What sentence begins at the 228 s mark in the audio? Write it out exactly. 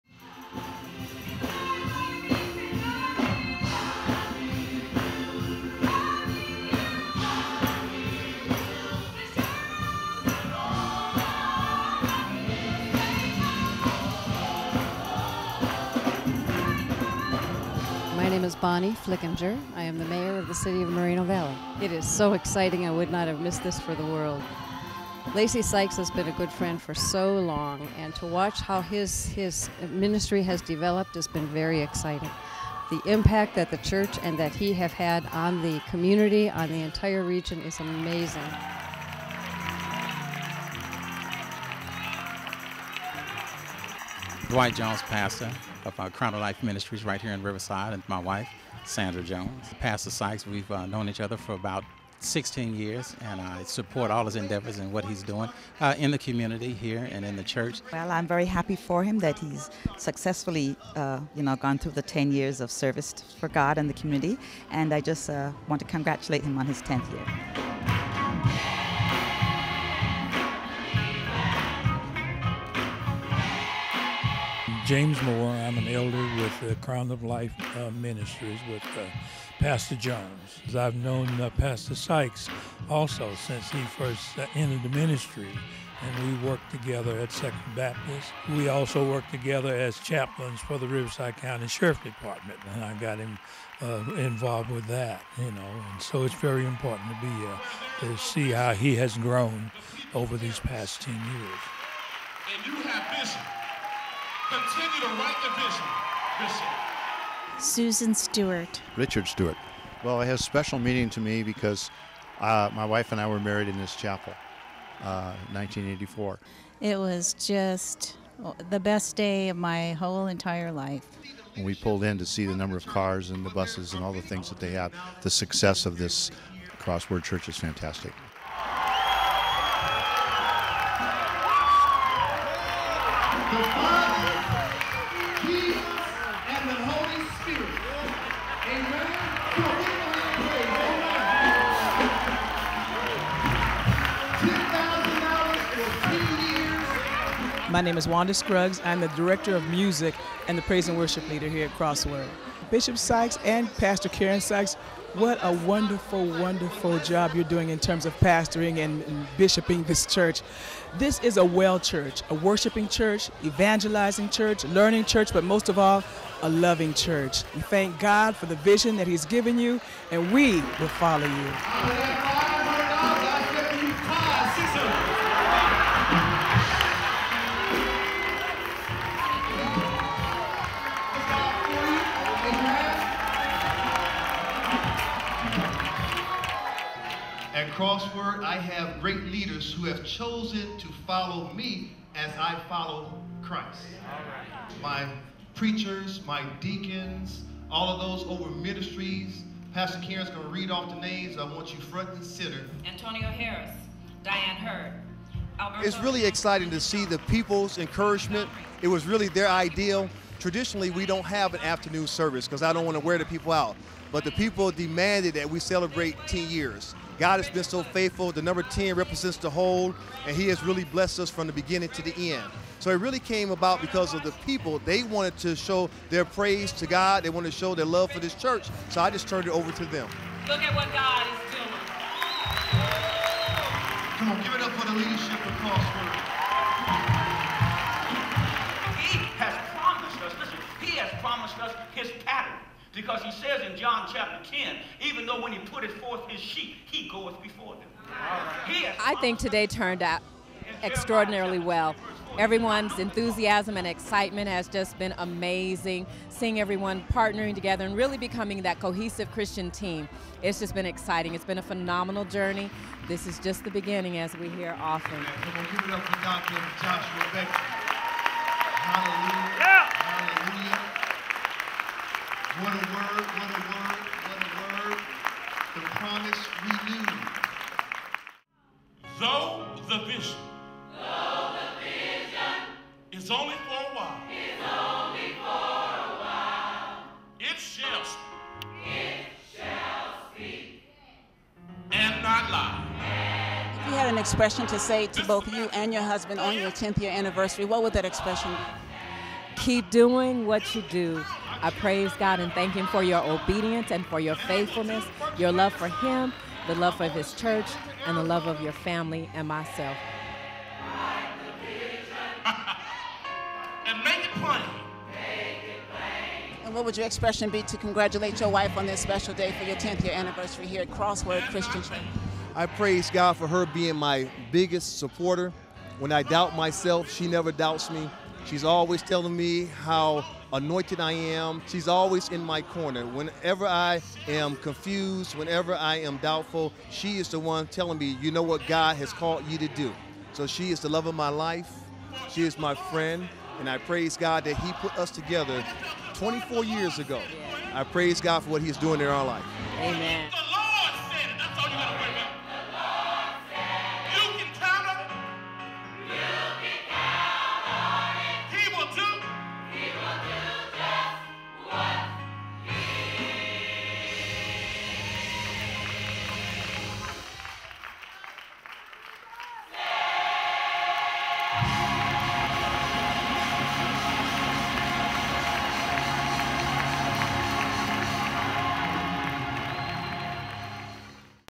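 So I just turned it over to them.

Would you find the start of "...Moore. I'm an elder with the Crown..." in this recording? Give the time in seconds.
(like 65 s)
75 s.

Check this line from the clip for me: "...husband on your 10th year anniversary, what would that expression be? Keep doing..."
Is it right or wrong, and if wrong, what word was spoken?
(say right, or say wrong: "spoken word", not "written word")
right.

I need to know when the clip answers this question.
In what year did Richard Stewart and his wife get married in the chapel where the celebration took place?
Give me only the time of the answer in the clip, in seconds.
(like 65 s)
115 s.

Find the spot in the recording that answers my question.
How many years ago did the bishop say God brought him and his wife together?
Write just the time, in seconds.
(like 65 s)
346 s.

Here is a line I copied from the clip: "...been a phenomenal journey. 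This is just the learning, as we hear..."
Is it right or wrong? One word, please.
wrong.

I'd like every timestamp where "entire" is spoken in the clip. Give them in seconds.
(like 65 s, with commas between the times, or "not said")
36 s, 120 s.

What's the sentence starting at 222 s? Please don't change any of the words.
So it really came about because of the people.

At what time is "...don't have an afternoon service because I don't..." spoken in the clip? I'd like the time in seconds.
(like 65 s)
211 s.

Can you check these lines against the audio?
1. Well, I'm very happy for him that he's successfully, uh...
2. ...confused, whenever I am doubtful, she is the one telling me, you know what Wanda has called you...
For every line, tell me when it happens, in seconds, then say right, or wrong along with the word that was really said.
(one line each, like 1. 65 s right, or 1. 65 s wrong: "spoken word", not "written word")
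1. 57 s right
2. 334 s wrong: "God", not "Wanda".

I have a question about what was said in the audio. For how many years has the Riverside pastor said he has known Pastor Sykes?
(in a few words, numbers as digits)
16.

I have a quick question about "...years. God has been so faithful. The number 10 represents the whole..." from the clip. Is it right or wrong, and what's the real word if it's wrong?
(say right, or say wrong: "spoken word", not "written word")
right.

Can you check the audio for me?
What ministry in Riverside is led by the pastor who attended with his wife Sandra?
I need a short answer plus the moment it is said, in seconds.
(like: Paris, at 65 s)
Crown of Life Ministries, at 46 s.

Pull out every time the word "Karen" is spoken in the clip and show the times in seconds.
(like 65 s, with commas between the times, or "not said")
154 s, 200 s.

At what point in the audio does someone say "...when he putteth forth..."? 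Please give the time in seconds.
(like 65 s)
245 s.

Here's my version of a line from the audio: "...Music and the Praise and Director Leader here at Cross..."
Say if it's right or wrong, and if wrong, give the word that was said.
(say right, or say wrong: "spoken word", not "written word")
wrong: "Worship", not "Director".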